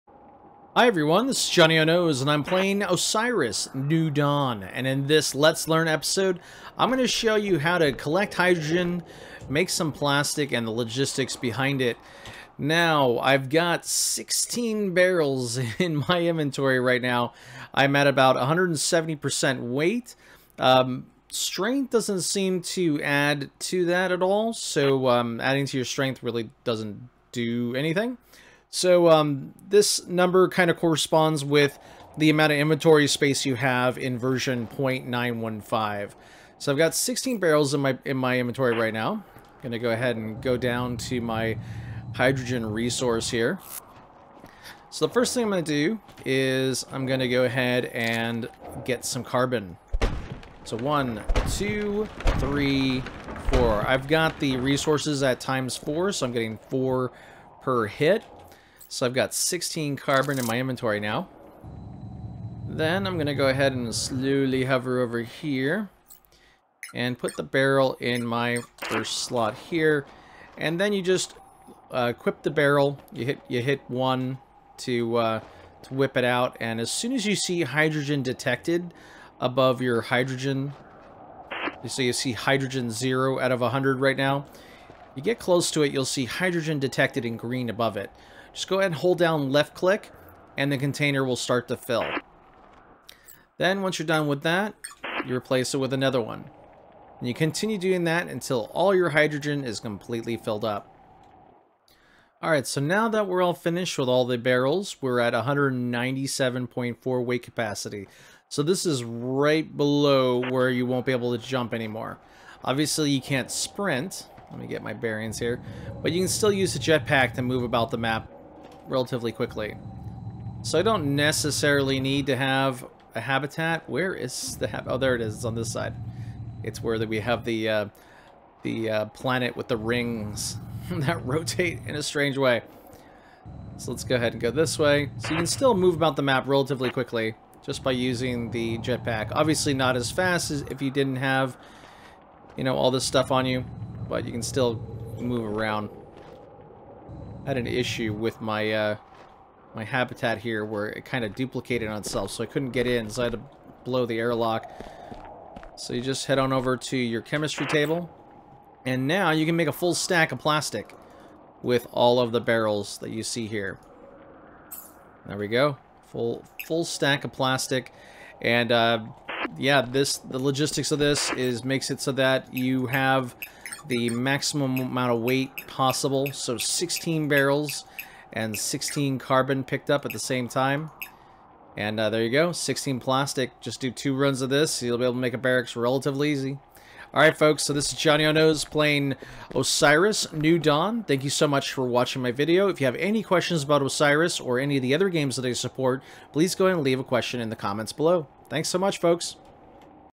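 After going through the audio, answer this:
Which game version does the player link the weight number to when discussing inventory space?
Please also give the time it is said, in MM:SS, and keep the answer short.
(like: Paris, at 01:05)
0.915, at 00:34.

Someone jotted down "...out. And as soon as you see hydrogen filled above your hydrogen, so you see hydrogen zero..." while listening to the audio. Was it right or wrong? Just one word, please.
wrong.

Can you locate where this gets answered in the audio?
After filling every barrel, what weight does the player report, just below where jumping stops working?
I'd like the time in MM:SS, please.
01:45.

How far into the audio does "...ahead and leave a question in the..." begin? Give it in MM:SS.
03:16.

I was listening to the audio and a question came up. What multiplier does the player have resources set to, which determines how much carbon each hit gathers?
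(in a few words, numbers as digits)
times four.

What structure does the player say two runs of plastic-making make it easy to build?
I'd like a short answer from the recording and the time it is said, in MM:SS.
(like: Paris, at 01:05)
a barracks, at 03:05.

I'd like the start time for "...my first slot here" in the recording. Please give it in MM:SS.
01:08.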